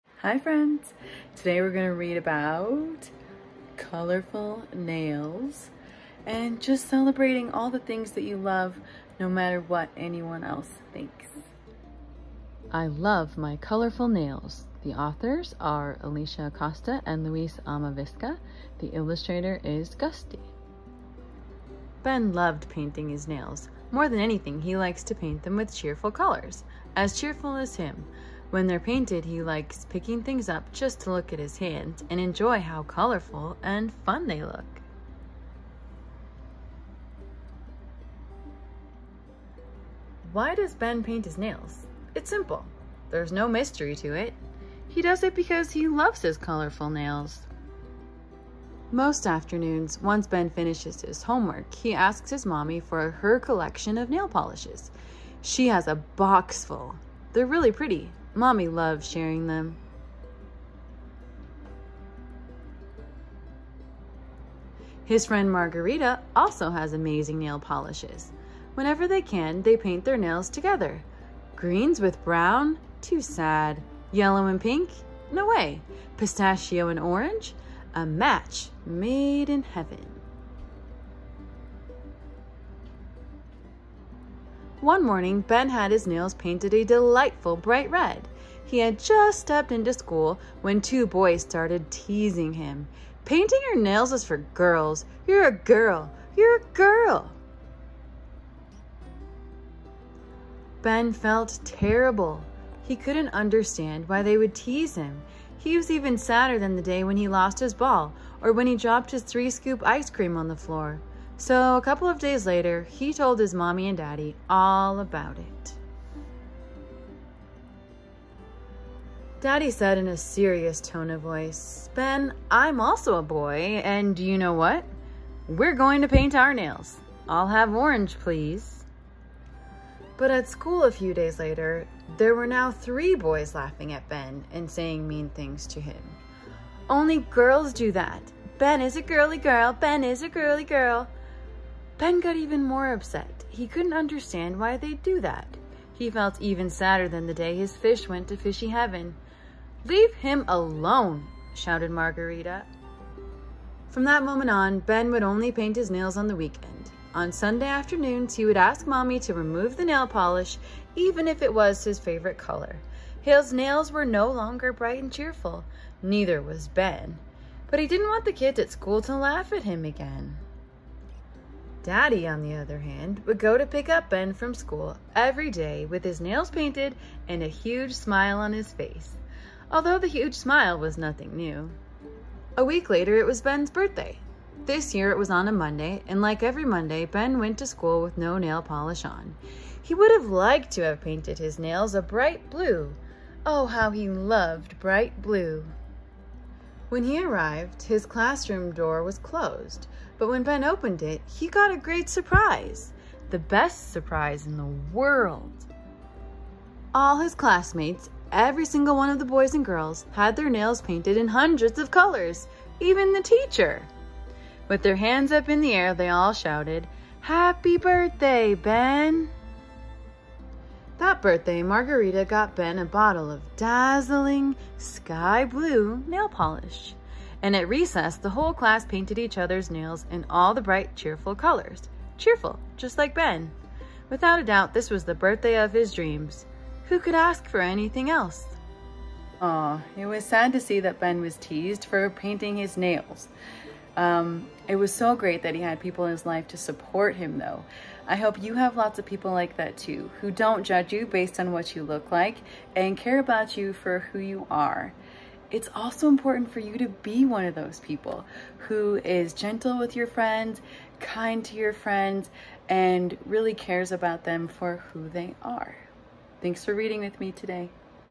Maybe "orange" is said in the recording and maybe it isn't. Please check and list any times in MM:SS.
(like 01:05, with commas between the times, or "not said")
01:16, 02:07.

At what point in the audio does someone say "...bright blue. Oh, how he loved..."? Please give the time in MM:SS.
03:12.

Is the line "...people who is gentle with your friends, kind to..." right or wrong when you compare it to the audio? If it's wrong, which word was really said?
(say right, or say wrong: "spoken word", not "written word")
right.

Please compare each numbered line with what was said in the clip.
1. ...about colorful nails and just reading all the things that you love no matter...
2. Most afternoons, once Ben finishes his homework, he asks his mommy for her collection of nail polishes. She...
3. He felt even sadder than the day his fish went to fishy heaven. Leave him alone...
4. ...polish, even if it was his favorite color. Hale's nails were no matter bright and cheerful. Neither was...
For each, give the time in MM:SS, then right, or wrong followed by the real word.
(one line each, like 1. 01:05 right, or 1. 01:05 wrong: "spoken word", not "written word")
1. 00:02 wrong: "celebrating", not "reading"
2. 00:48 right
3. 02:25 right
4. 02:40 wrong: "longer", not "matter".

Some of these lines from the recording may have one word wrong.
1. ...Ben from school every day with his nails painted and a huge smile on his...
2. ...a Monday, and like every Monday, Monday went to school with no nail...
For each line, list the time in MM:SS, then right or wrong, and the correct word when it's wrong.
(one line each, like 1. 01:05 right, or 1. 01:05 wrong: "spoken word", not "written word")
1. 02:54 right
2. 03:05 wrong: "Ben", not "Monday".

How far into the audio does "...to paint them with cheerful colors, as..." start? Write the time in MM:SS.
00:25.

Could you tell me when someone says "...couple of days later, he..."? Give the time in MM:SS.
01:51.